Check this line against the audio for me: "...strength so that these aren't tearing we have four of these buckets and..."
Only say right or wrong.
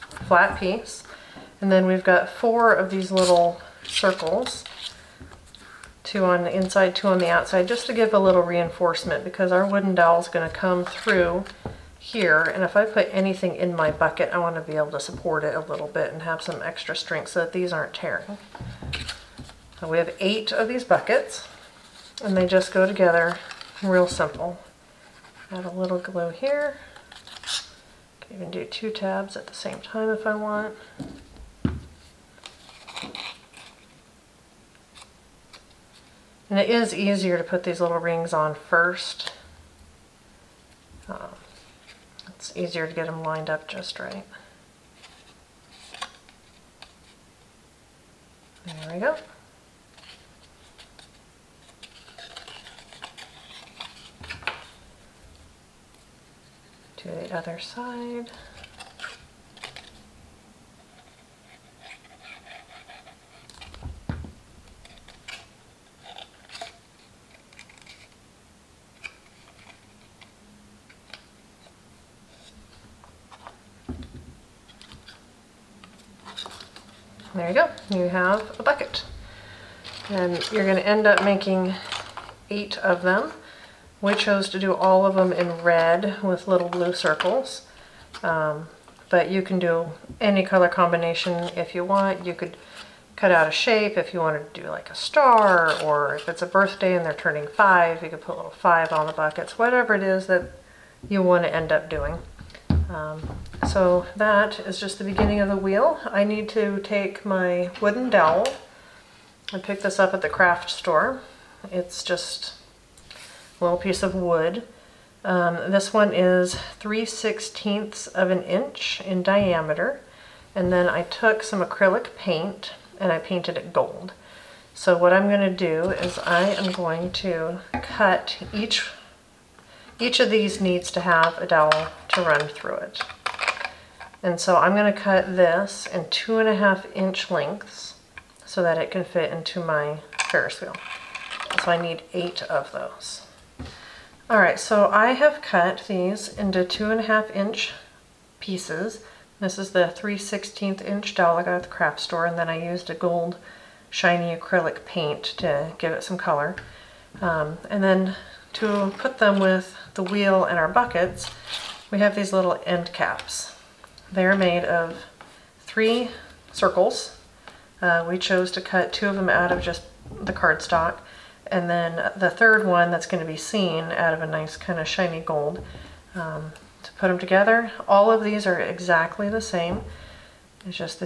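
wrong.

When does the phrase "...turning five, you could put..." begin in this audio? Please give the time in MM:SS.
01:37.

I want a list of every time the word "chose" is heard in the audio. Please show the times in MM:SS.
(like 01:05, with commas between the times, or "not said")
01:24, 02:48.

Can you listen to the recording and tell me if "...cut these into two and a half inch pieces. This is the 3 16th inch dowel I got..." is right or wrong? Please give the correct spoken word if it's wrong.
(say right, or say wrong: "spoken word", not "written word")
right.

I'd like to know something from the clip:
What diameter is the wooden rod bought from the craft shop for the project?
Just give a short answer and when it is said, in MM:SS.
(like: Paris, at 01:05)
3/16 inch, at 01:56.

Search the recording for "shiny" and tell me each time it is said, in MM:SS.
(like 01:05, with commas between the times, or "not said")
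02:33, 02:54.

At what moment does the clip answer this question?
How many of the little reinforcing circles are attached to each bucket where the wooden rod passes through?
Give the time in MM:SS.
00:02.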